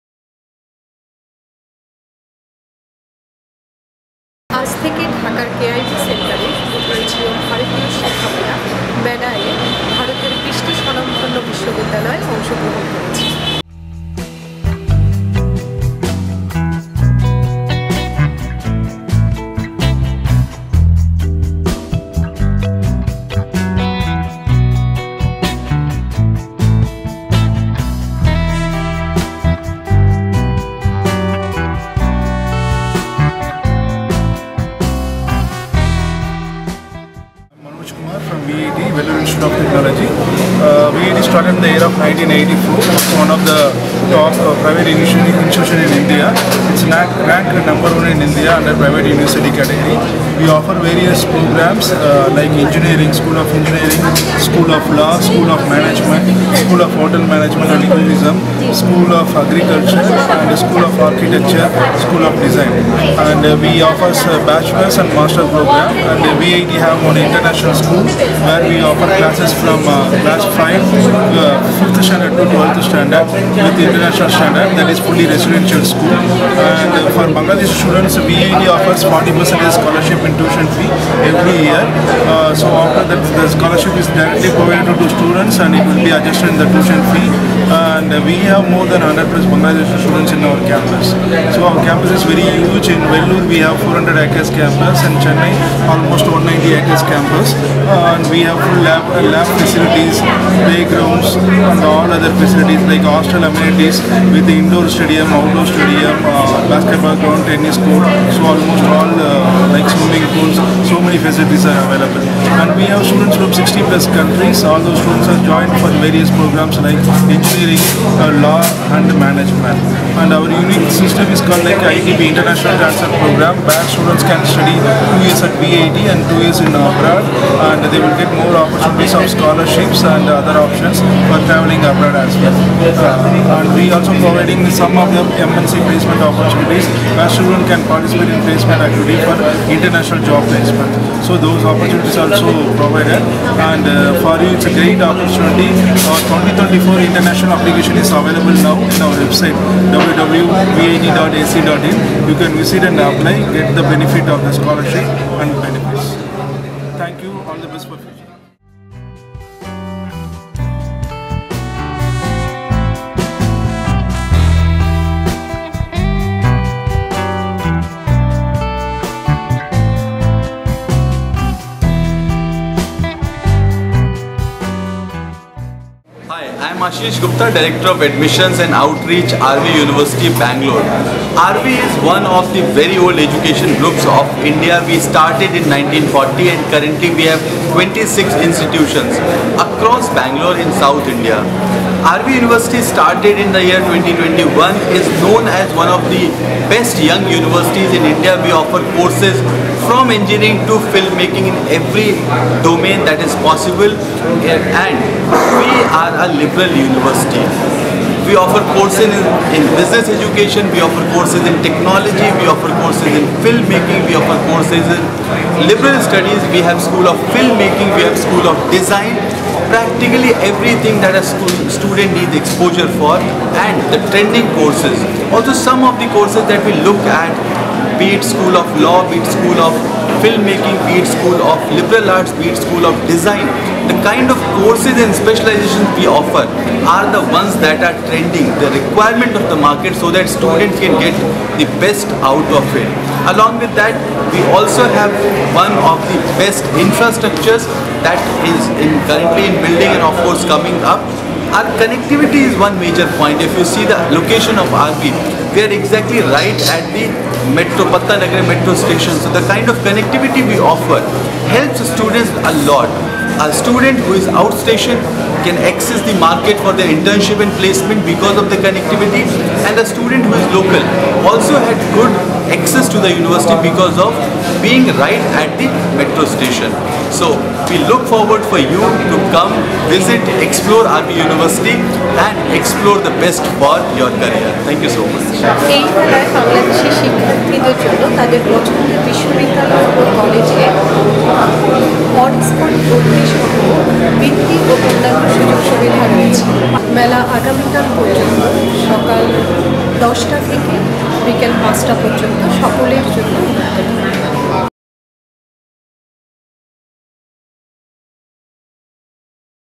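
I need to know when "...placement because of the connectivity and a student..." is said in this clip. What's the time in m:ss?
4:27.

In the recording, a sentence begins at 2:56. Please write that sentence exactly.
I am Ashish Gupta, Director of Admissions and Outreach, RV University, Bangalore.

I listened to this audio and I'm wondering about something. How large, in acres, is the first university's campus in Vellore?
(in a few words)
400 acres.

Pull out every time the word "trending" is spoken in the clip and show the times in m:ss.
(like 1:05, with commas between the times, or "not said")
3:44, 3:58.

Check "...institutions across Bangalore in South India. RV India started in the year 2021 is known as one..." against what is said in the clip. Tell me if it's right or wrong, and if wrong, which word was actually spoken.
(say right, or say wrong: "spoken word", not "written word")
wrong: "University", not "India".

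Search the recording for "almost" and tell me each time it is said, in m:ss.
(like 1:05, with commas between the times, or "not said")
1:35, 1:48.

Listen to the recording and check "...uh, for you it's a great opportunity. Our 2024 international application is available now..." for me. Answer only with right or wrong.
right.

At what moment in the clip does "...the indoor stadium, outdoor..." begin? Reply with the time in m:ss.
1:44.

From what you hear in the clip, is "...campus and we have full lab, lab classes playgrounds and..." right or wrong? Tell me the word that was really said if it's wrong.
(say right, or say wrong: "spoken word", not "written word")
wrong: "facilities", not "classes".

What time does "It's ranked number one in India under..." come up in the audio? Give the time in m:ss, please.
0:46.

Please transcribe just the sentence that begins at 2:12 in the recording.
Uh, we also providing some of the MNC placement opportunities where students can participate in placement activity for international job placement.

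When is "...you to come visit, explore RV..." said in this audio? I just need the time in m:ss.
4:38.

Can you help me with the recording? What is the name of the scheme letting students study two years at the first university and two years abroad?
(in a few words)
International Transfer Program.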